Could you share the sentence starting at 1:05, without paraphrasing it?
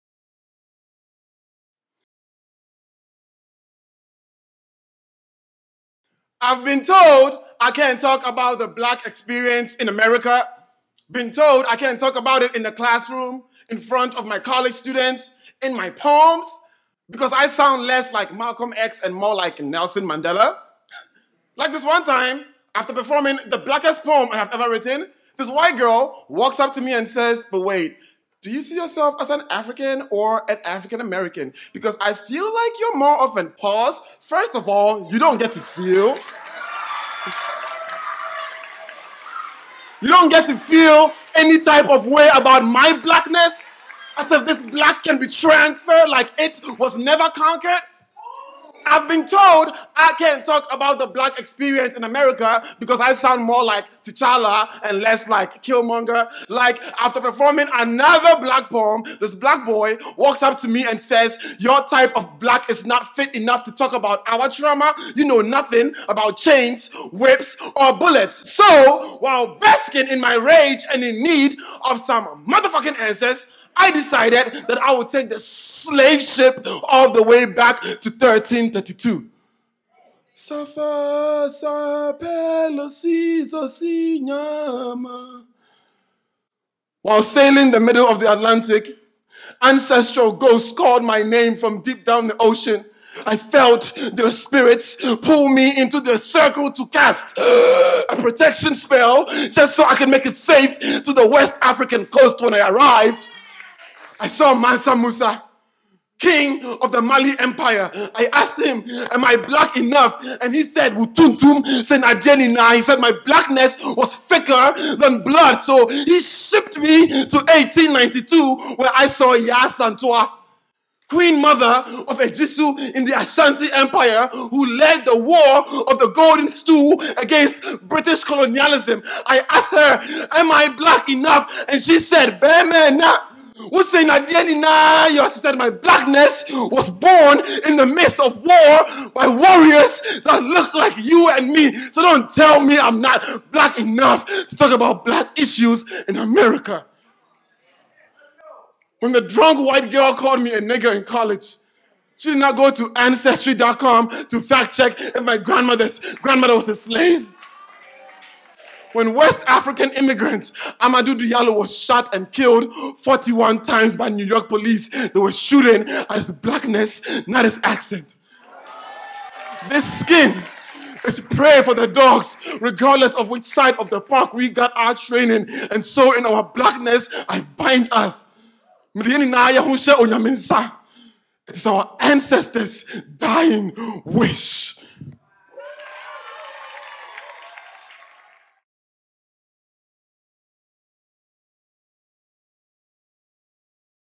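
You know nothing about chains, whips, or bullets.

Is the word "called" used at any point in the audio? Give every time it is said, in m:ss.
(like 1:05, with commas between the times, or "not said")
1:30, 2:30.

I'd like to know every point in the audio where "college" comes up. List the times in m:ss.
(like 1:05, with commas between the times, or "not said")
0:14, 2:31.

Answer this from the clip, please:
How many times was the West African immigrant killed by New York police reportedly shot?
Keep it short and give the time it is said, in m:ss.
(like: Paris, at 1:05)
41, at 2:42.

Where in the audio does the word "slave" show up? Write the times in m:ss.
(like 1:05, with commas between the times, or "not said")
1:15, 2:36.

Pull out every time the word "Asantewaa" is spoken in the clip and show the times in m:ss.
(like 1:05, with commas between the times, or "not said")
1:59.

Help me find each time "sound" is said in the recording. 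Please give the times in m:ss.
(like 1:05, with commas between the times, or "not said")
0:17, 0:53.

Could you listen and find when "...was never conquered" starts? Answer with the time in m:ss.
0:46.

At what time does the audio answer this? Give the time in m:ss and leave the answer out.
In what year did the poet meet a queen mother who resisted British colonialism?
1:57.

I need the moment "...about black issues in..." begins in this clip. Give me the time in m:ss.
2:24.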